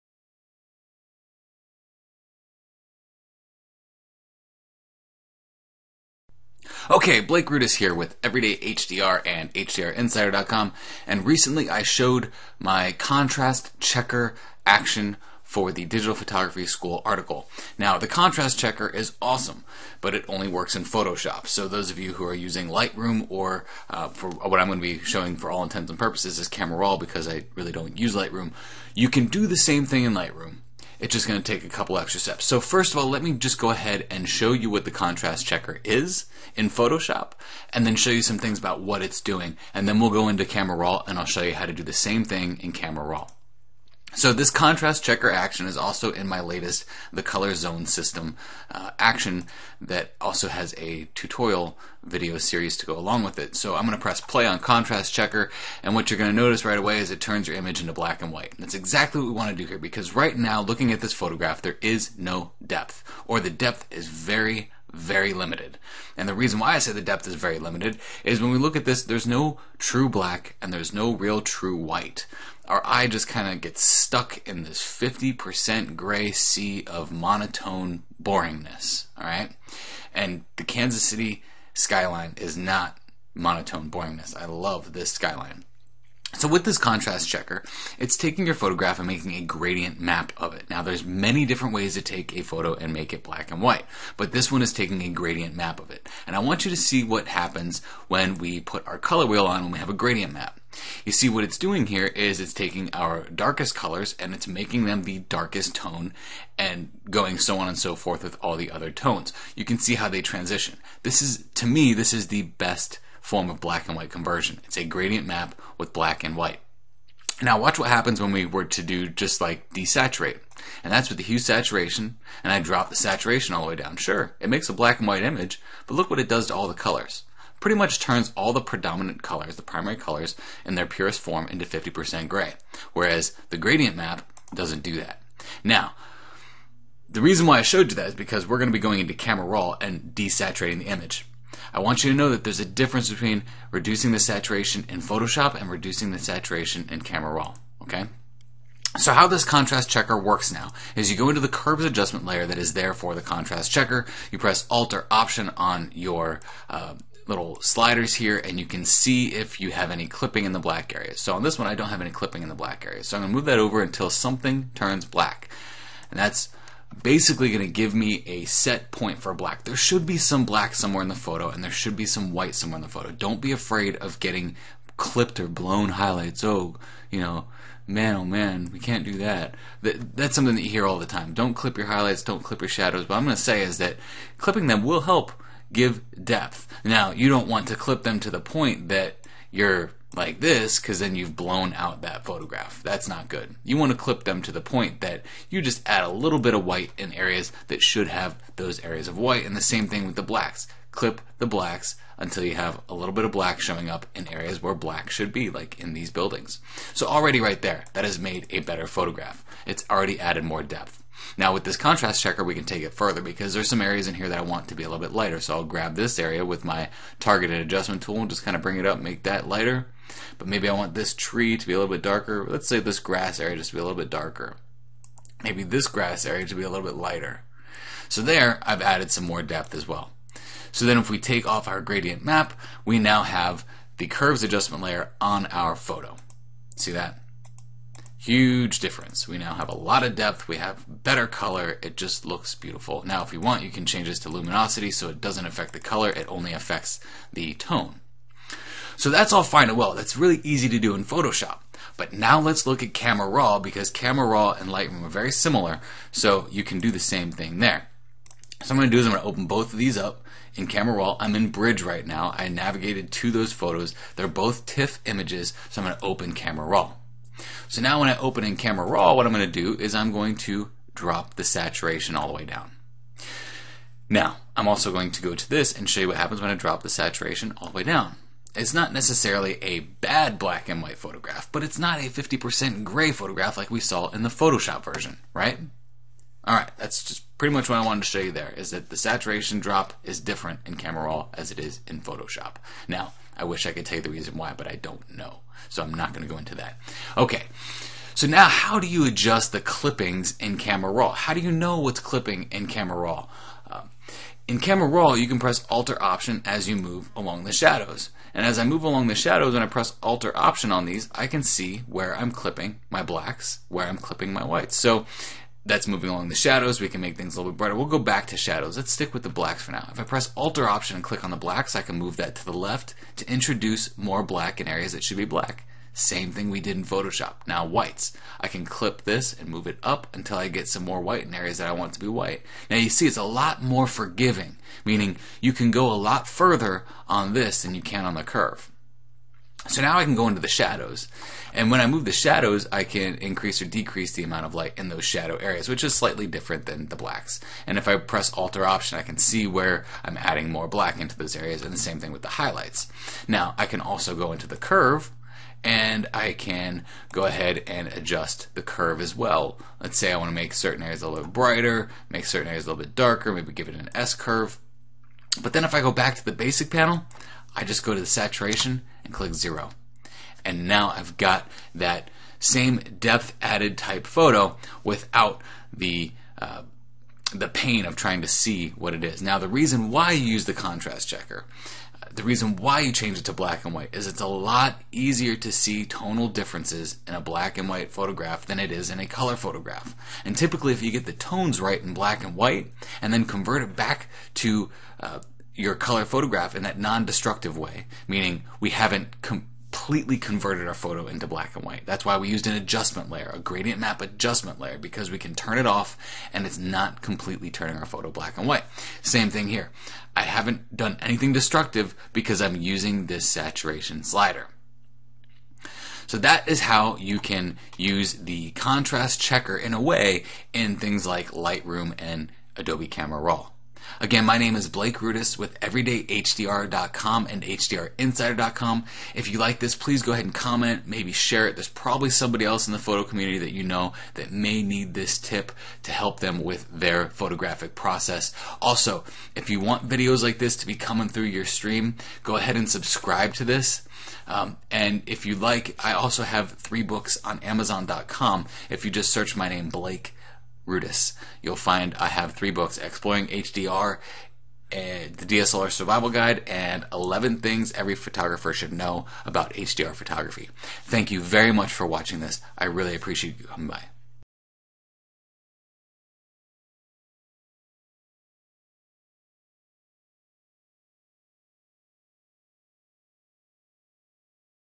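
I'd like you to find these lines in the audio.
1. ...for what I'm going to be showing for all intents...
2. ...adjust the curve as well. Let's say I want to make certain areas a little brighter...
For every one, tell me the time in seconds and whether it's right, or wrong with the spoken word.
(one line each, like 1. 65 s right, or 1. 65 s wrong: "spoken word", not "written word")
1. 24 s right
2. 357 s right.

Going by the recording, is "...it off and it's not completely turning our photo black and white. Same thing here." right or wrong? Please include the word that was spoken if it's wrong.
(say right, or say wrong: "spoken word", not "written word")
right.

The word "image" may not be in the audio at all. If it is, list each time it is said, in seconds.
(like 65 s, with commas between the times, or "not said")
57 s, 125 s, 140 s, 265 s.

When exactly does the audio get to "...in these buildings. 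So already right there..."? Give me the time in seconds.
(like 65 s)
205 s.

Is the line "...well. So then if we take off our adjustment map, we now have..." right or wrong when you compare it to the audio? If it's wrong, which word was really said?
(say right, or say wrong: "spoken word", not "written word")
wrong: "gradient", not "adjustment".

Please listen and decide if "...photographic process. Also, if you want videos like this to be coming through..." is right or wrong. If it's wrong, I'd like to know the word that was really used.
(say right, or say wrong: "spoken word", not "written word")
right.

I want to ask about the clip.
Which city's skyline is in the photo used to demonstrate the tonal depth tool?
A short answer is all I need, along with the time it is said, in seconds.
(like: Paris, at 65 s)
Kansas City, at 80 s.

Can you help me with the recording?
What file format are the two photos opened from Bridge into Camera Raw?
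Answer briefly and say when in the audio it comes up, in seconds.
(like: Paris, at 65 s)
TIFF, at 264 s.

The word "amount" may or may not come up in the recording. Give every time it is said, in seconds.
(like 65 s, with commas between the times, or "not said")
344 s.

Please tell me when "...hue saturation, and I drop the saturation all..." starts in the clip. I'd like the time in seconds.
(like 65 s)
121 s.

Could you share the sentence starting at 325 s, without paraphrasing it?
Same thing we did in Photoshop.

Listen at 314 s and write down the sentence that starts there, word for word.
So that's moving along the shadows.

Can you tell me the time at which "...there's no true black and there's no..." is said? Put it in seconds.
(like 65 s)
69 s.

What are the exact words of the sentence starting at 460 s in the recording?
Thank you very much for watching this.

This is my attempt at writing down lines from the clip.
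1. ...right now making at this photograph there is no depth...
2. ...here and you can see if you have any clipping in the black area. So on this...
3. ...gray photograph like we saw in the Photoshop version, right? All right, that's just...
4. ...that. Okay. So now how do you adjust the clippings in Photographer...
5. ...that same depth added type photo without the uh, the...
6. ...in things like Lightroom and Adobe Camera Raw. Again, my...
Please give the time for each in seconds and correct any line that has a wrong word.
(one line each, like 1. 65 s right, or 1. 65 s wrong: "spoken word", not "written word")
1. 60 s wrong: "looking", not "making"
2. 158 s right
3. 282 s right
4. 296 s wrong: "Camera", not "Photographer"
5. 371 s right
6. 420 s right.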